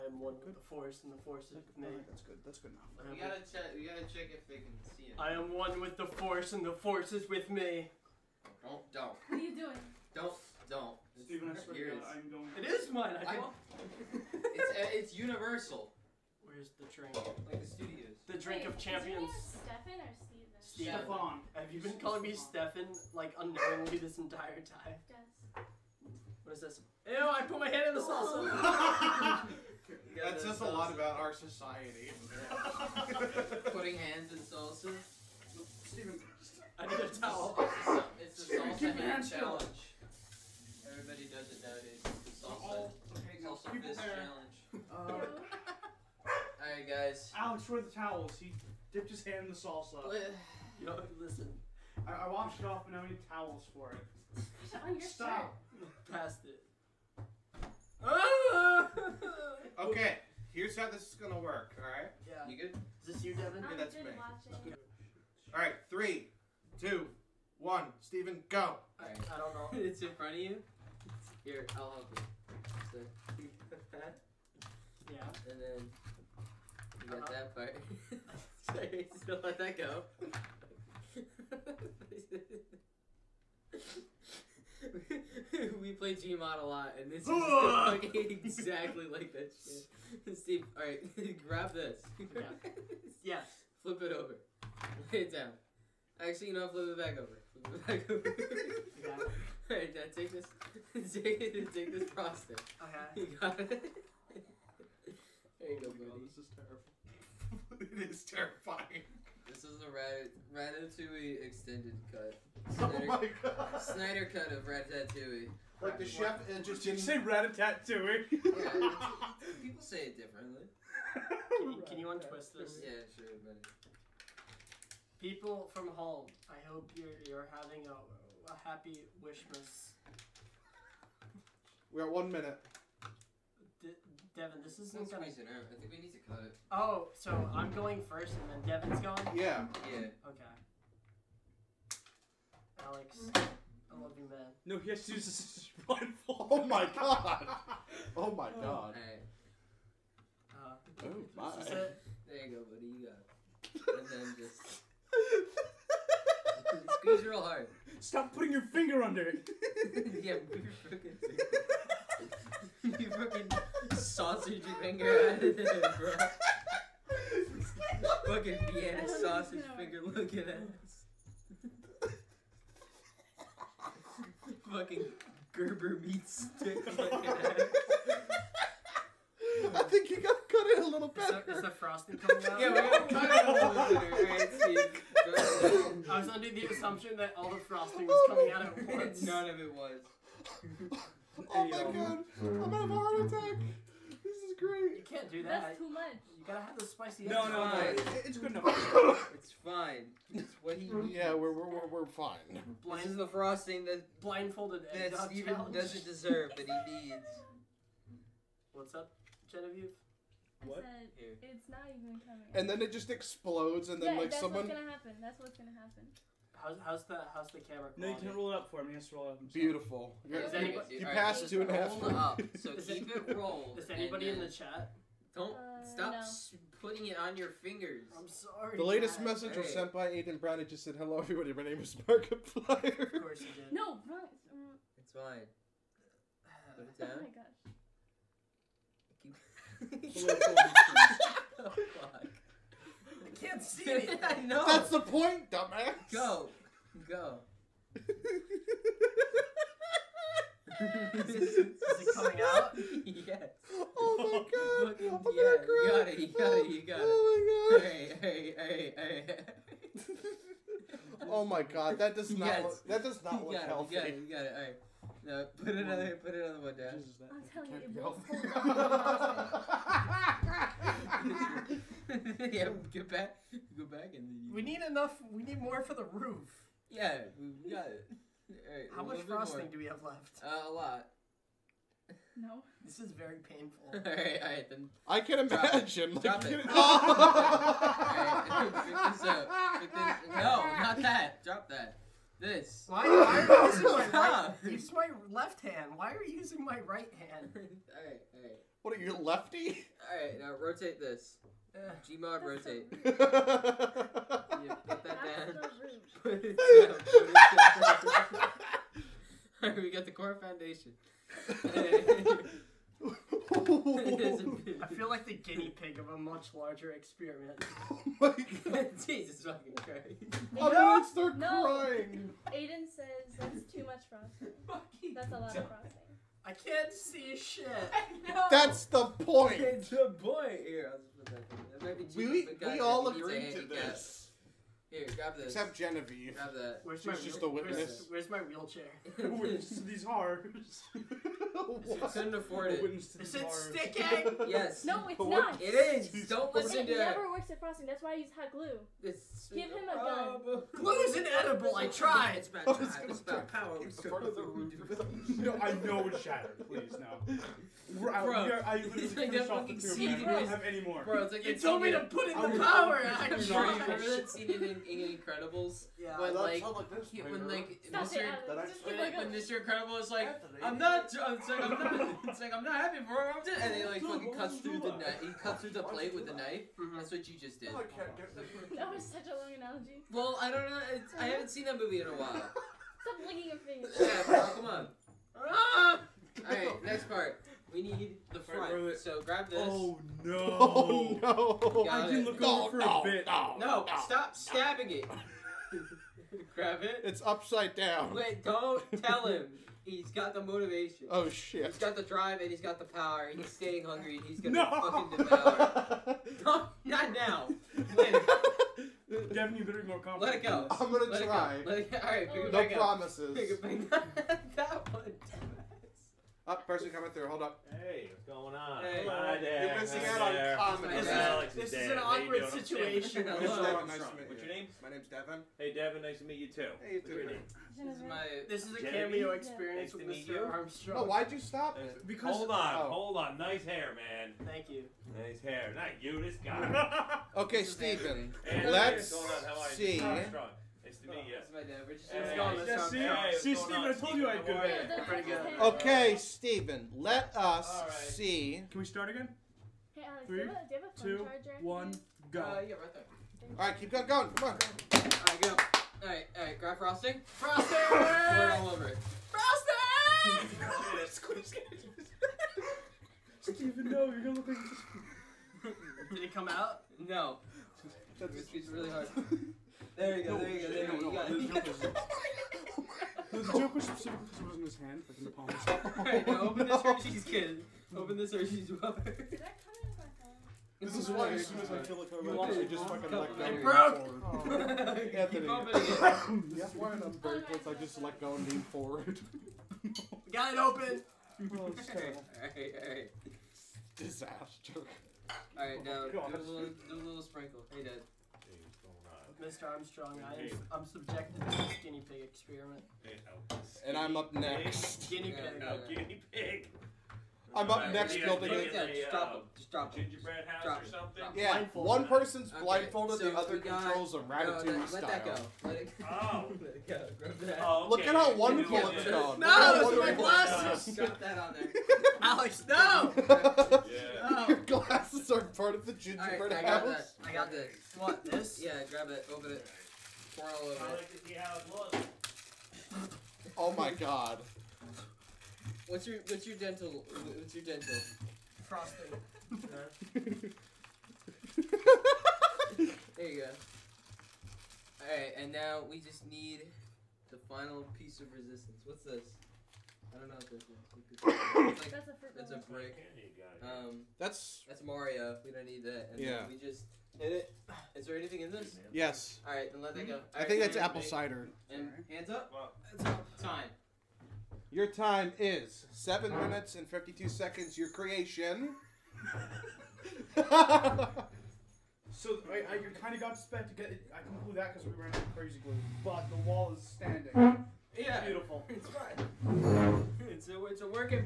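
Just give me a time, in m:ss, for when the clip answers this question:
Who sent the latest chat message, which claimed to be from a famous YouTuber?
3:50.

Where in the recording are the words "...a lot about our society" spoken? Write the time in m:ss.
0:30.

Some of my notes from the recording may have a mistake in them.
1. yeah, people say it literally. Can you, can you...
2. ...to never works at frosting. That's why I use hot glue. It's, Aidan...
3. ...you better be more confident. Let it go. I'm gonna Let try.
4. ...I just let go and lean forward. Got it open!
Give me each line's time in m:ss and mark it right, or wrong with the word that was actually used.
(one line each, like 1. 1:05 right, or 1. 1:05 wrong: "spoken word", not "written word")
1. 1:58 wrong: "differently", not "literally"
2. 5:46 wrong: "Give", not "Aidan"
3. 6:49 right
4. 8:07 right.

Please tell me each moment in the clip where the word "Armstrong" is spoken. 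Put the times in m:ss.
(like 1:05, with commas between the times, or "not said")
7:10, 8:19.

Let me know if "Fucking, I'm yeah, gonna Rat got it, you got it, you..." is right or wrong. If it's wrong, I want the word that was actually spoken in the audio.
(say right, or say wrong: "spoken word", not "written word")
wrong: "You", not "Rat".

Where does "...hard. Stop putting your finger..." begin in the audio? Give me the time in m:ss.
2:37.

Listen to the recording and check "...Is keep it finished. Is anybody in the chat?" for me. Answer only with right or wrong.
wrong.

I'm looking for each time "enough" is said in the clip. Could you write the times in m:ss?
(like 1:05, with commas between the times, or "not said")
0:02, 3:18, 4:34.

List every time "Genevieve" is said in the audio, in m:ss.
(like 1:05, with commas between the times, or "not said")
3:29, 5:35.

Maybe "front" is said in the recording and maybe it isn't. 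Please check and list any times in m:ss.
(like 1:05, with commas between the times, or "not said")
1:10, 6:28.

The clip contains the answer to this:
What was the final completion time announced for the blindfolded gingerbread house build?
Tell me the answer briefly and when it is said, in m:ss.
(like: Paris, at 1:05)
7 minutes 52 seconds, at 9:25.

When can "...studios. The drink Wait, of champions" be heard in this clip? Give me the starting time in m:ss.
0:17.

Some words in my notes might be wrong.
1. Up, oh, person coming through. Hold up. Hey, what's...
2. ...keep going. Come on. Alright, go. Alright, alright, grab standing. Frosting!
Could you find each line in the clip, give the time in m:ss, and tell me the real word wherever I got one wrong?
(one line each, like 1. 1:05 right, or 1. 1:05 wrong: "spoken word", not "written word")
1. 6:56 right
2. 7:33 wrong: "frosting", not "standing".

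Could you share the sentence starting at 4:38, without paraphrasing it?
Right, How much frosting do we have left?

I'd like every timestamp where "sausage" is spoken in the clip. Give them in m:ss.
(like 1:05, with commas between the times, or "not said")
2:43, 2:49.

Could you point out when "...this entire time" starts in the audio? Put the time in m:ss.
0:23.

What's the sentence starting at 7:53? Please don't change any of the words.
The joke was specifically was in his hand, like in the palm.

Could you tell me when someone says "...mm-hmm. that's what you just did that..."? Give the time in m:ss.
6:16.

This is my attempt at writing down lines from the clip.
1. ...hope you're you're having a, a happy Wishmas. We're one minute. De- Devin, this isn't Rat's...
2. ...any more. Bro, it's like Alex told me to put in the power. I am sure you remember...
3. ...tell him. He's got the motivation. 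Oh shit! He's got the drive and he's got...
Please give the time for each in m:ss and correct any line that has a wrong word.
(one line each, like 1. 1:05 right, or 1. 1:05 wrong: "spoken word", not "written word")
1. 2:06 wrong: "That", not "Rat"
2. 6:00 wrong: "You", not "Alex"
3. 6:39 right.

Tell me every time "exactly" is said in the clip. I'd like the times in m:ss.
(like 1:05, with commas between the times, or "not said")
1:28.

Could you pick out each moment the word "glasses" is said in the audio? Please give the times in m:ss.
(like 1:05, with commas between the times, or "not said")
8:40, 8:44.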